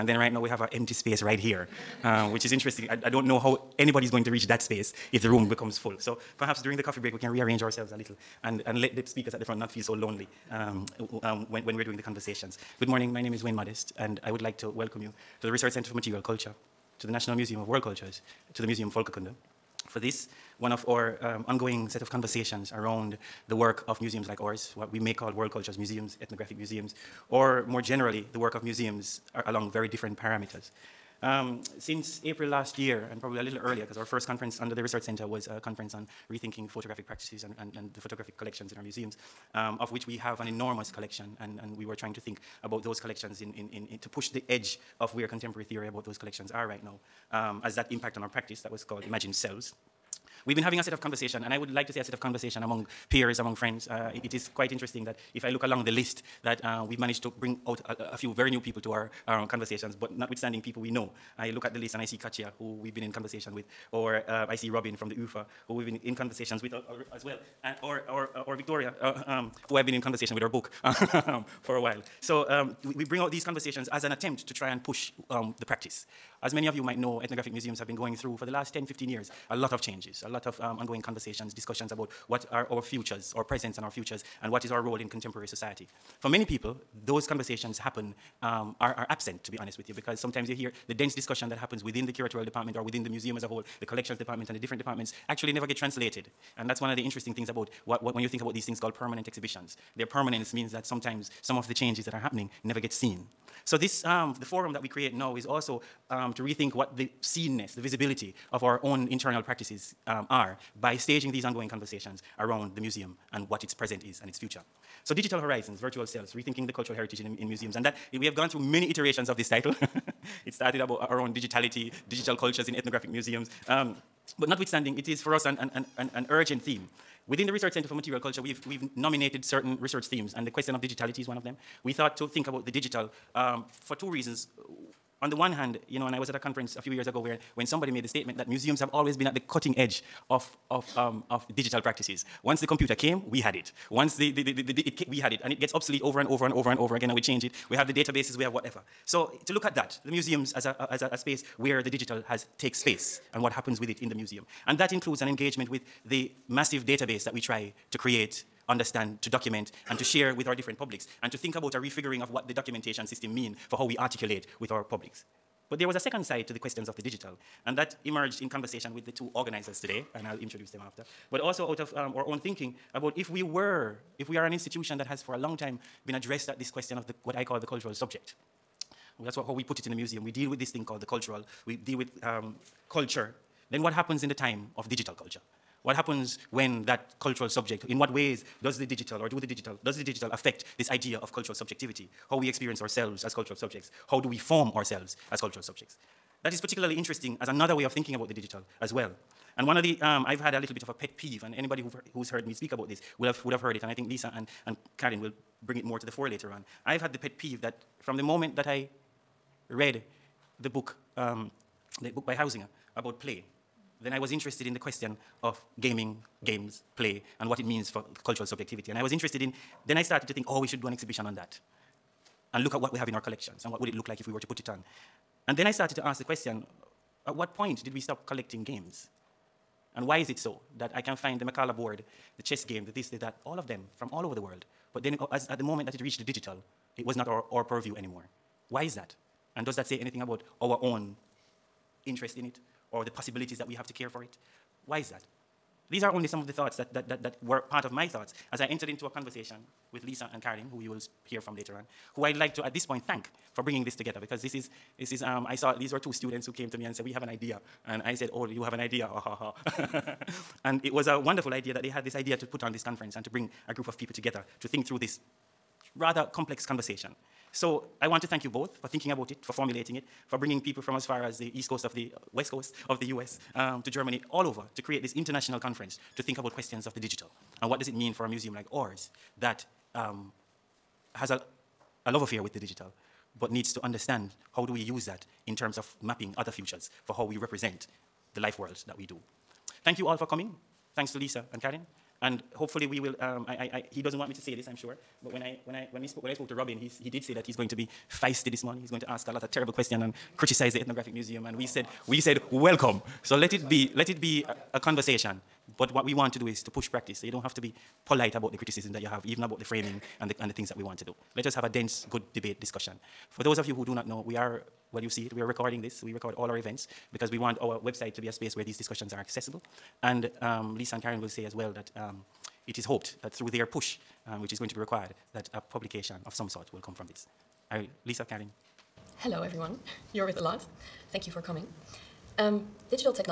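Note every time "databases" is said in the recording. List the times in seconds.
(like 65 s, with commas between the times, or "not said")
147 s, 156 s.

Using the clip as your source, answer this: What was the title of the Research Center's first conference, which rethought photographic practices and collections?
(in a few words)
Imagine Selves.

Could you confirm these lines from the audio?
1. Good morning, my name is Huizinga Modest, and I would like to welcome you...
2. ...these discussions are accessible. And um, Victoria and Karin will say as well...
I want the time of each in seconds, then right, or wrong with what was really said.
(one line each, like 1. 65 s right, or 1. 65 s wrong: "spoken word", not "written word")
1. 12 s wrong: "Wayne", not "Huizinga"
2. 318 s wrong: "Liza", not "Victoria".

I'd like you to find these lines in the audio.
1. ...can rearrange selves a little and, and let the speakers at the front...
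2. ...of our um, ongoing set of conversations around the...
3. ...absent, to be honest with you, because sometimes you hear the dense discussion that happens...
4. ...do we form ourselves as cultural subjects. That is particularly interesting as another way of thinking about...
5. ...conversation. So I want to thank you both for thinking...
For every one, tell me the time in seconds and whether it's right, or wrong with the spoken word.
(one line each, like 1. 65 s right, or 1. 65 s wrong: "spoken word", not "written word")
1. 7 s wrong: "ourselves", not "selves"
2. 20 s right
3. 89 s right
4. 194 s right
5. 266 s right.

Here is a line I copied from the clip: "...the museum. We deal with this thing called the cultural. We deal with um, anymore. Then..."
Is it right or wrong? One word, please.
wrong.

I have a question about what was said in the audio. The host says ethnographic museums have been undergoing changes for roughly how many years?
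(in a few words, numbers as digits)
10, 15 years.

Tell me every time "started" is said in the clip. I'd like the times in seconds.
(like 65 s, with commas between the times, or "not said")
120 s, 220 s, 225 s.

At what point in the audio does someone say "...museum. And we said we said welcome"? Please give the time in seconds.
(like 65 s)
301 s.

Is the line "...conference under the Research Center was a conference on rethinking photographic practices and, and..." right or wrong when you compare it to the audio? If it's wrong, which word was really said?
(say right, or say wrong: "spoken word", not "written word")
right.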